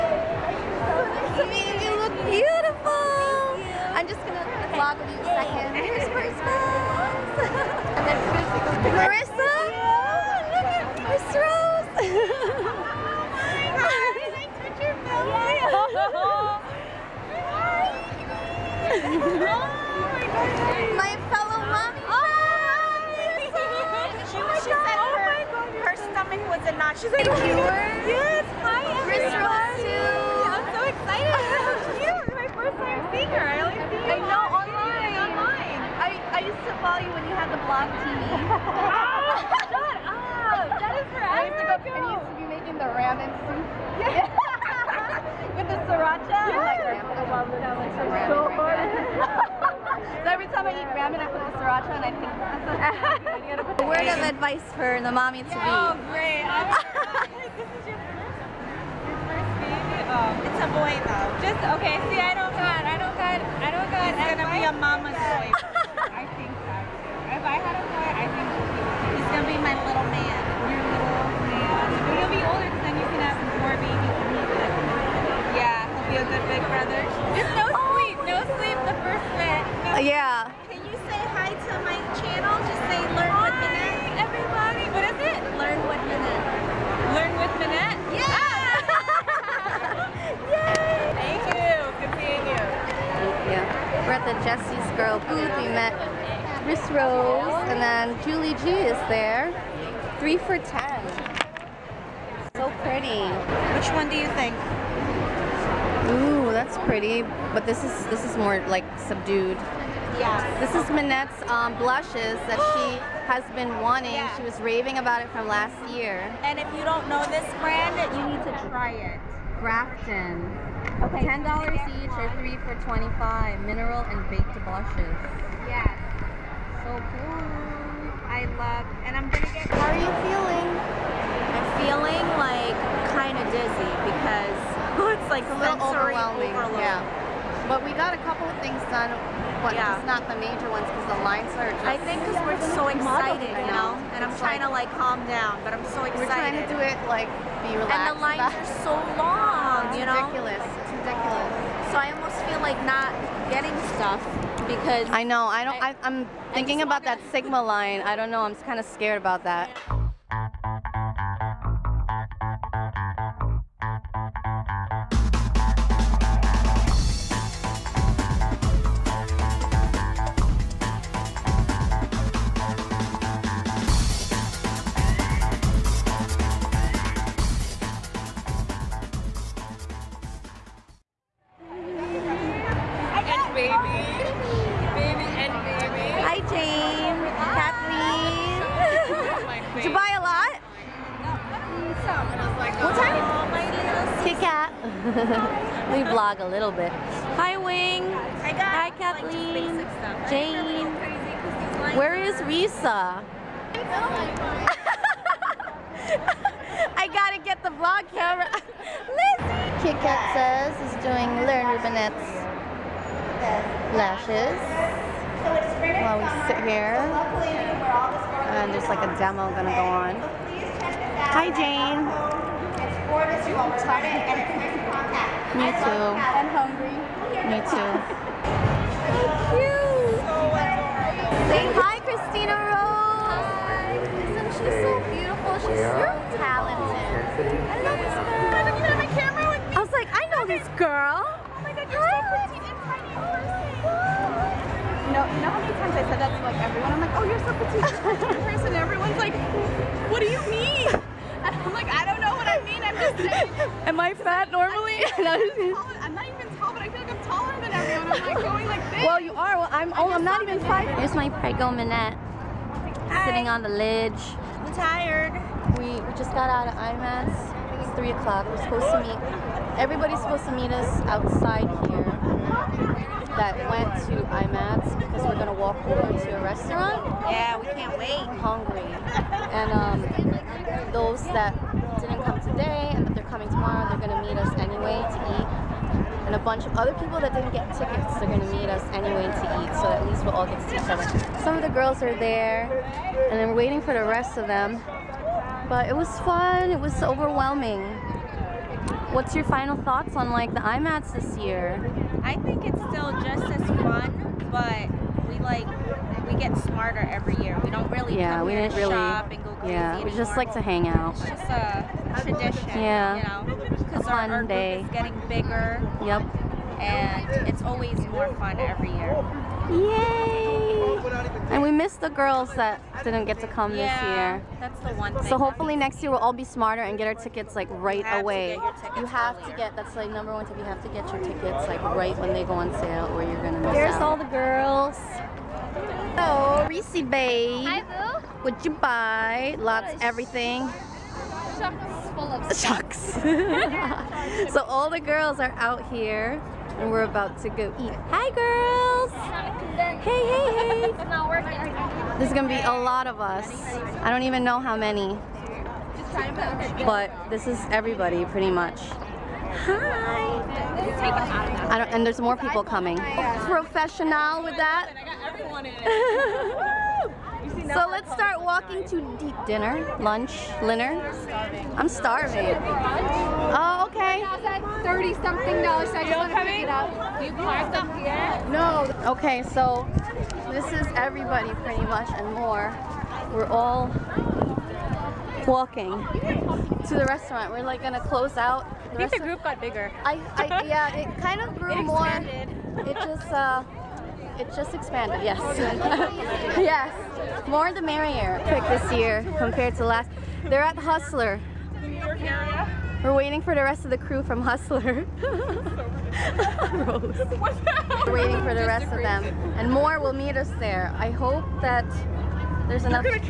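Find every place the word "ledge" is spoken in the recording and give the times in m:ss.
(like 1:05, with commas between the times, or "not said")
4:23.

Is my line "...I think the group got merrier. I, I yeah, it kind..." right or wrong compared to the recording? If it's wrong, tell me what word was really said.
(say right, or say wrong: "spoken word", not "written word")
wrong: "bigger", not "merrier".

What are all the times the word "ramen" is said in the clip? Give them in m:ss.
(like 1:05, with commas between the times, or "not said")
0:42, 0:50.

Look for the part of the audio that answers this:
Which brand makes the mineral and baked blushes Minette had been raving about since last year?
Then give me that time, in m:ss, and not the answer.
1:59.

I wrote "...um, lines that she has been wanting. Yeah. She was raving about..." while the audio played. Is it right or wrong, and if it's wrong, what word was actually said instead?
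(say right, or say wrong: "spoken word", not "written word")
wrong: "blushes", not "lines".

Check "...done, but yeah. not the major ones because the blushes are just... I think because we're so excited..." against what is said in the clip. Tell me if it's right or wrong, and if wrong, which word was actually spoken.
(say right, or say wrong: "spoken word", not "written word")
wrong: "lines", not "blushes".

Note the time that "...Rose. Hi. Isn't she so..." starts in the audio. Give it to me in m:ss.
3:52.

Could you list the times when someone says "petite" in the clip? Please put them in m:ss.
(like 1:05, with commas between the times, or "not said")
4:07.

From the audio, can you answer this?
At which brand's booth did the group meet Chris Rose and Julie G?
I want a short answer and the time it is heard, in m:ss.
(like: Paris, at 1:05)
Jesse's Girl, at 1:34.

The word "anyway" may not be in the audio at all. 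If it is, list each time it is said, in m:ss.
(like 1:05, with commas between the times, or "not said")
4:44, 4:48.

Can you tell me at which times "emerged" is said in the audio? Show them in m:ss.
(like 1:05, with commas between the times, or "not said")
not said.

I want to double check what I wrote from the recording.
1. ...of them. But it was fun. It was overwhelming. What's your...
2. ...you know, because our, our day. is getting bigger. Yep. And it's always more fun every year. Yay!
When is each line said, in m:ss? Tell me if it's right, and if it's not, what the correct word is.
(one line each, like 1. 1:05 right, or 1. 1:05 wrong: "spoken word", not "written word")
1. 4:54 right
2. 5:13 right.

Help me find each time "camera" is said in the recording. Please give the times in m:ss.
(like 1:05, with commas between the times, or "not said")
3:28, 3:59.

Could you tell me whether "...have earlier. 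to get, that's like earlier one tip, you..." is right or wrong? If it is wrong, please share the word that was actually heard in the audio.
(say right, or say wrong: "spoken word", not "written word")
wrong: "number", not "earlier".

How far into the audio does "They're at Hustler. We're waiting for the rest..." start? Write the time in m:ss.
6:40.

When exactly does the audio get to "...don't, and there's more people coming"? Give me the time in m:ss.
6:01.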